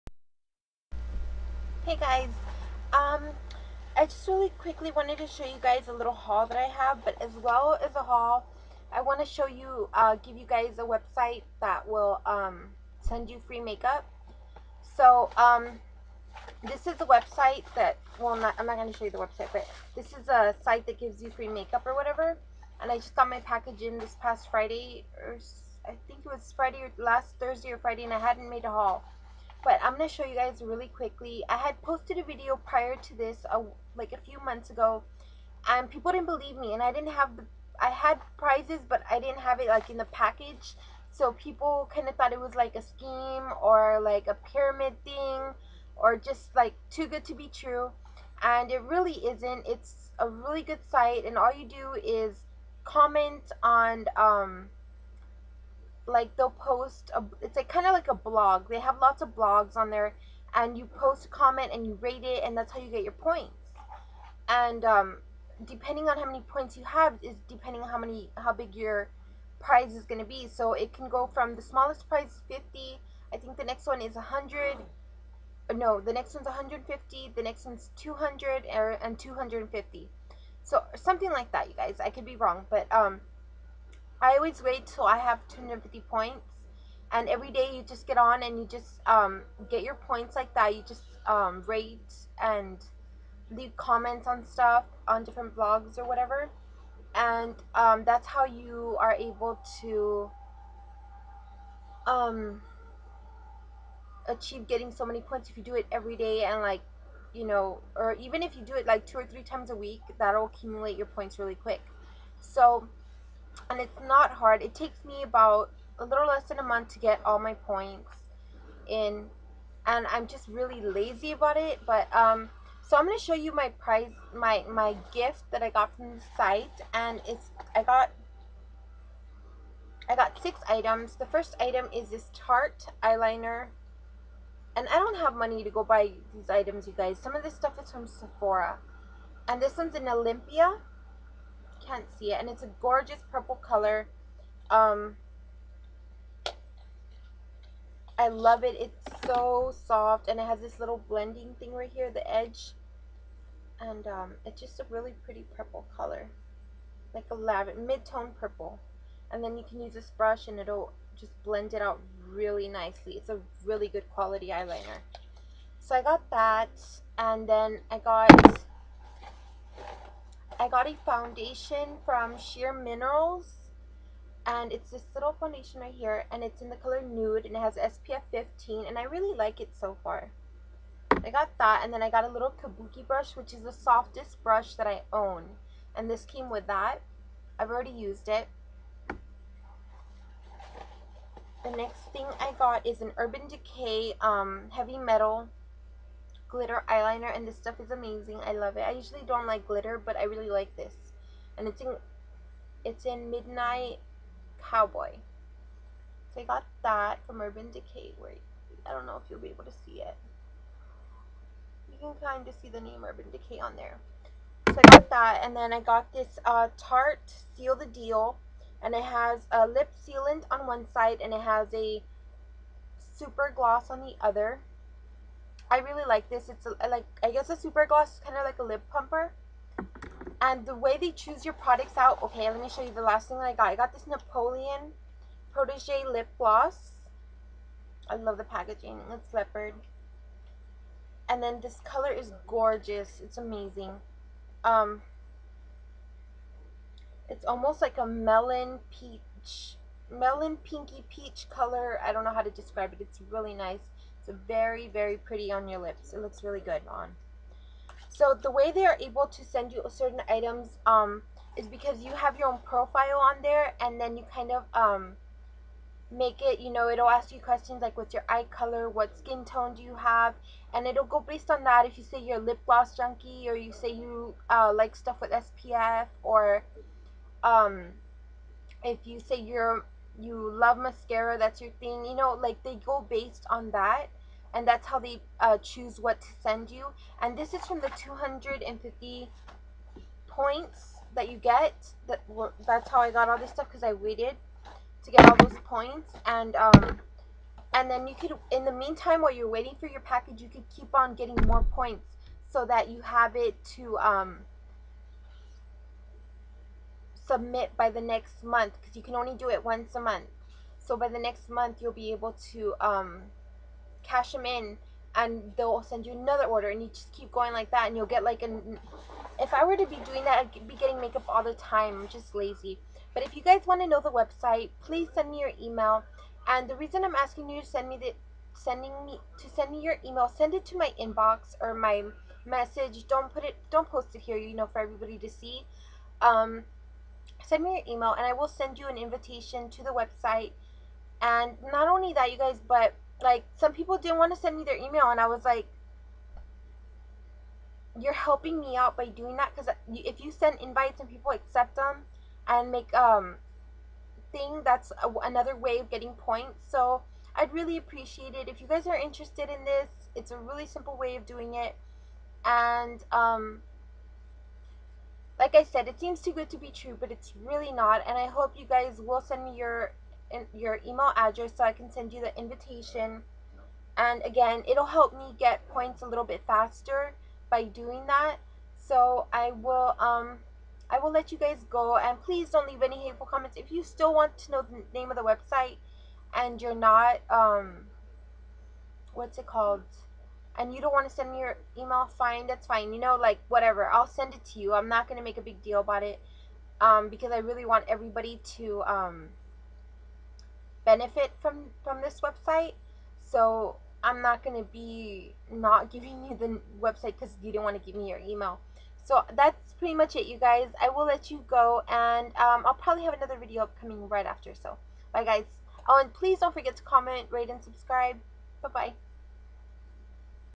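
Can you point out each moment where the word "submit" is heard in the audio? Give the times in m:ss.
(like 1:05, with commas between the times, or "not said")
5:07.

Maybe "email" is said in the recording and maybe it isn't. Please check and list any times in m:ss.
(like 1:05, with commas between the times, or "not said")
5:25, 5:30, 5:37, 5:44, 6:10, 6:31, 6:48.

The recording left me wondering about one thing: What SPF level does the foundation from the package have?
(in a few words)
15.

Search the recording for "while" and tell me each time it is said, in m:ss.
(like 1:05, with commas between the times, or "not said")
4:59.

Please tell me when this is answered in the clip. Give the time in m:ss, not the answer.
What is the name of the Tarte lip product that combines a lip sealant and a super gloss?
3:37.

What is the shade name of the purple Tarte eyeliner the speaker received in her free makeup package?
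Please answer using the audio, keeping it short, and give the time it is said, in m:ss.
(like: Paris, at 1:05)
Olympia, at 2:20.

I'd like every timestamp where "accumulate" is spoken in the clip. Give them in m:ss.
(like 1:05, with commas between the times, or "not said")
1:50.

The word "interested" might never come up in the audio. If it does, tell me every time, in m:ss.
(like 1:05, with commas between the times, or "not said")
5:58.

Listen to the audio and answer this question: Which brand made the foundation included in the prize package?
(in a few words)
Sheer Minerals.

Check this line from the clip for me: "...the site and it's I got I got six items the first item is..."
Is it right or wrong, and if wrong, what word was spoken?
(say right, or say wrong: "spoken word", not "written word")
right.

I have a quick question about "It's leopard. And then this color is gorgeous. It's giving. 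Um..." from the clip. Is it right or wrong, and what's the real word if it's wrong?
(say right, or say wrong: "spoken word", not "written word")
wrong: "amazing", not "giving".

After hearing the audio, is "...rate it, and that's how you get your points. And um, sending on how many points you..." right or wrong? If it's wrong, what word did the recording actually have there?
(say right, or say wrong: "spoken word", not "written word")
wrong: "depending", not "sending".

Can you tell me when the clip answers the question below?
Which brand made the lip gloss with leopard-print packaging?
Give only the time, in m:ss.
3:54.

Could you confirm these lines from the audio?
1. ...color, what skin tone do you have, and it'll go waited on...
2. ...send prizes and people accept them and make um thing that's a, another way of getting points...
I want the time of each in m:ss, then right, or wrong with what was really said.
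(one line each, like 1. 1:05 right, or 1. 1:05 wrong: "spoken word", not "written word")
1. 4:28 wrong: "based", not "waited"
2. 5:50 wrong: "invites", not "prizes".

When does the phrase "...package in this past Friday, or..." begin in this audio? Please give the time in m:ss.
0:23.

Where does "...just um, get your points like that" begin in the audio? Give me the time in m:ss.
1:28.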